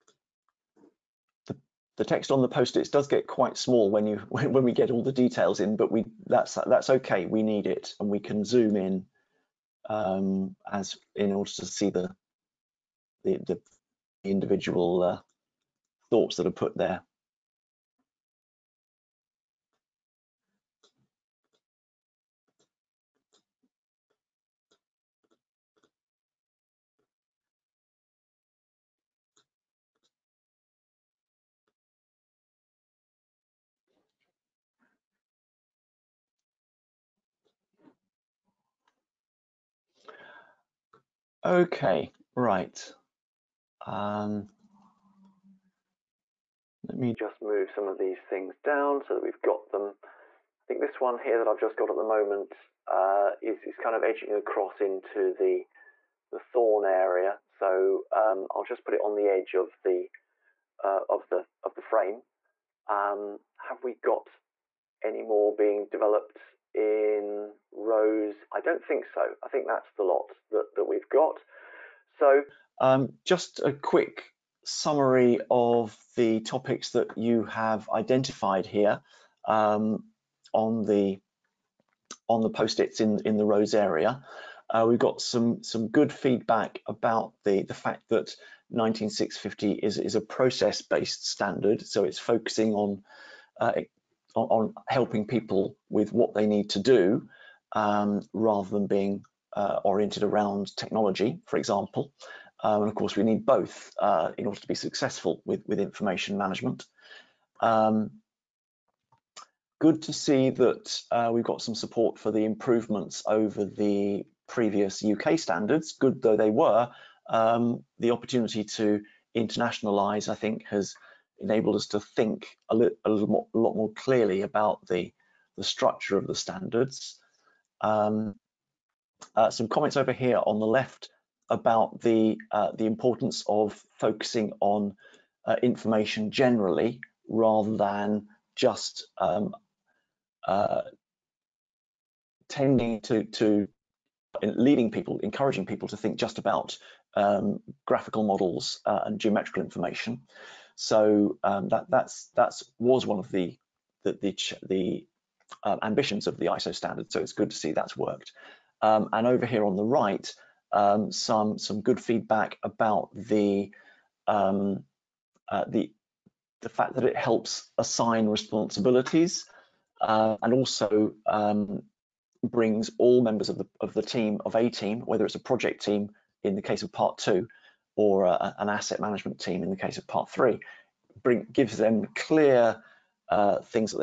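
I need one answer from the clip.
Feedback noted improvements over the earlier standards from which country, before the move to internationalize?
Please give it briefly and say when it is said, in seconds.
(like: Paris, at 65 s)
UK, at 115 s.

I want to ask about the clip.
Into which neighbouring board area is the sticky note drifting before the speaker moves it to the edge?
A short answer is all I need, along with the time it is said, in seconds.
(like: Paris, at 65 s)
thorn area, at 56 s.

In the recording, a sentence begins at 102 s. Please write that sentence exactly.
Uh, and of course, we need both uh, in order to be successful with, with information management.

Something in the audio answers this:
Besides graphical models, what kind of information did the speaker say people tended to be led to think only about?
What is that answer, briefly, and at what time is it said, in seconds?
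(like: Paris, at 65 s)
geometrical information, at 149 s.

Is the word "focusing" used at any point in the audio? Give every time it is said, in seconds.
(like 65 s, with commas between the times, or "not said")
92 s, 133 s.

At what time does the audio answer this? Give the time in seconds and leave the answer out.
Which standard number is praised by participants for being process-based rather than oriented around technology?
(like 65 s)
88 s.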